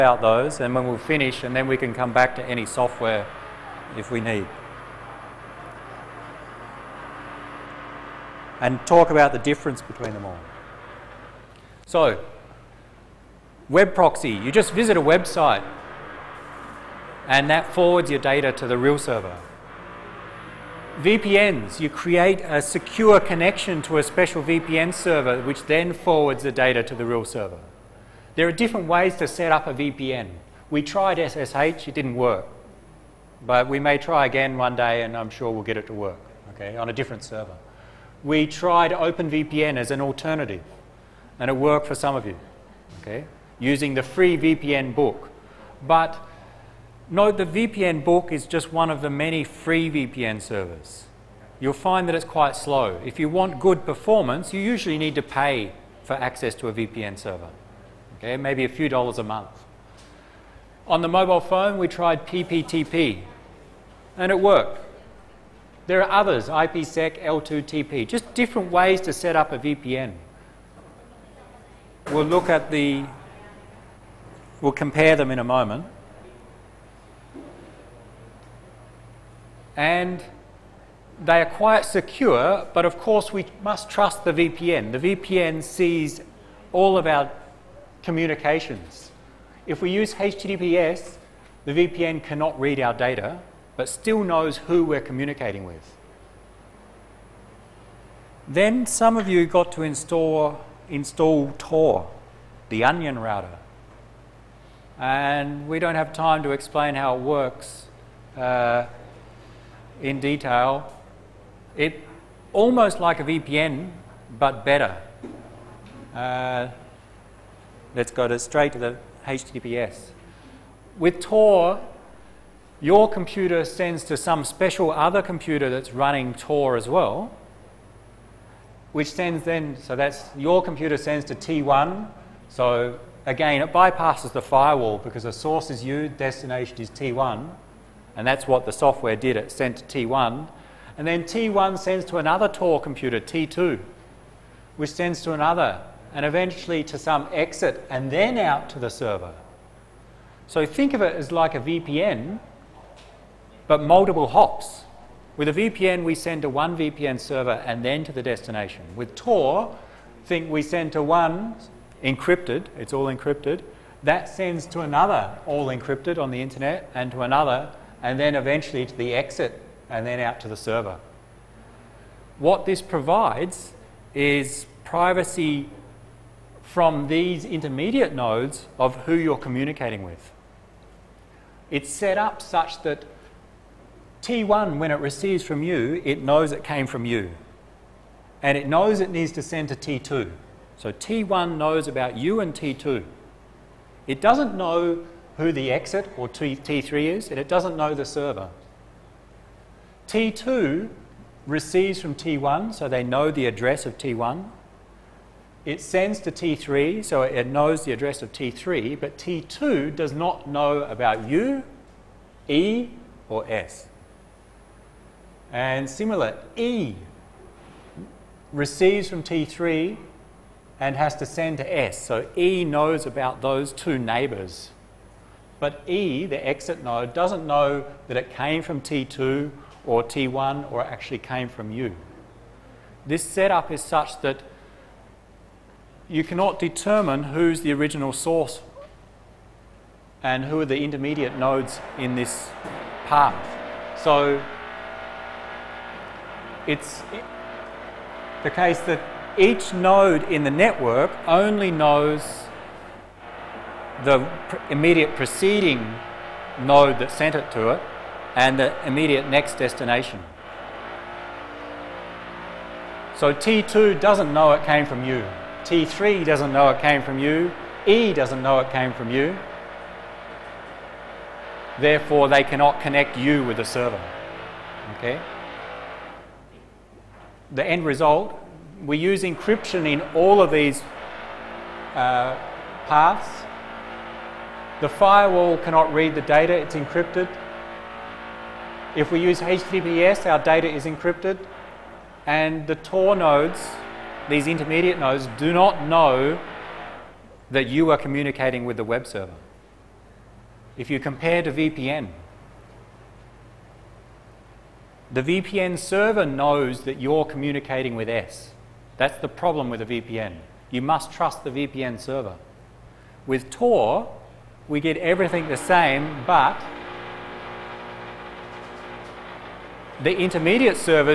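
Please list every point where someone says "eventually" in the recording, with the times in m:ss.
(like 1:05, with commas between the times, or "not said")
2:26, 2:48.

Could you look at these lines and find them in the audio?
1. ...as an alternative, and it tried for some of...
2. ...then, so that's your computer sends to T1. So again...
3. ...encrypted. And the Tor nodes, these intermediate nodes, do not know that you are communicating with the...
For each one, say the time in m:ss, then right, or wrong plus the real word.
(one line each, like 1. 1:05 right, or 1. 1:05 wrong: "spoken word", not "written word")
1. 0:39 wrong: "worked", not "tried"
2. 2:09 right
3. 4:50 right.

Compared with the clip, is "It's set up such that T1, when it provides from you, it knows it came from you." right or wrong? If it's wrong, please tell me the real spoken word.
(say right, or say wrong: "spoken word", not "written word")
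wrong: "receives", not "provides".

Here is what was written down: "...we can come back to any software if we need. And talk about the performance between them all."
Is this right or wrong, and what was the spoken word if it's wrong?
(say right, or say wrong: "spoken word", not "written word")
wrong: "difference", not "performance".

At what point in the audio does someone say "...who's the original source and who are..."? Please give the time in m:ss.
3:57.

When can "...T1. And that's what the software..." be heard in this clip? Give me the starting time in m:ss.
2:16.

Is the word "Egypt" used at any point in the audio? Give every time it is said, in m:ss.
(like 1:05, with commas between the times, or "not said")
not said.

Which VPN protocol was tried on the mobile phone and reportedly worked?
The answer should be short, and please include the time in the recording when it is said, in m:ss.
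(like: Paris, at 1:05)
PPTP, at 1:02.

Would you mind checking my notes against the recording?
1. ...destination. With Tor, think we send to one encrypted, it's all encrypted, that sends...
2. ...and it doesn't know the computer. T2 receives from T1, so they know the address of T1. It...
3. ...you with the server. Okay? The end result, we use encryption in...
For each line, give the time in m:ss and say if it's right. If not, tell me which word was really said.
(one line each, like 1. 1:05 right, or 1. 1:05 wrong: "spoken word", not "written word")
1. 2:38 right
2. 3:17 wrong: "server", not "computer"
3. 4:33 right.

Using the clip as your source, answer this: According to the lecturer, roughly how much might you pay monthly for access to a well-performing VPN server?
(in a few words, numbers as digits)
a few dollars.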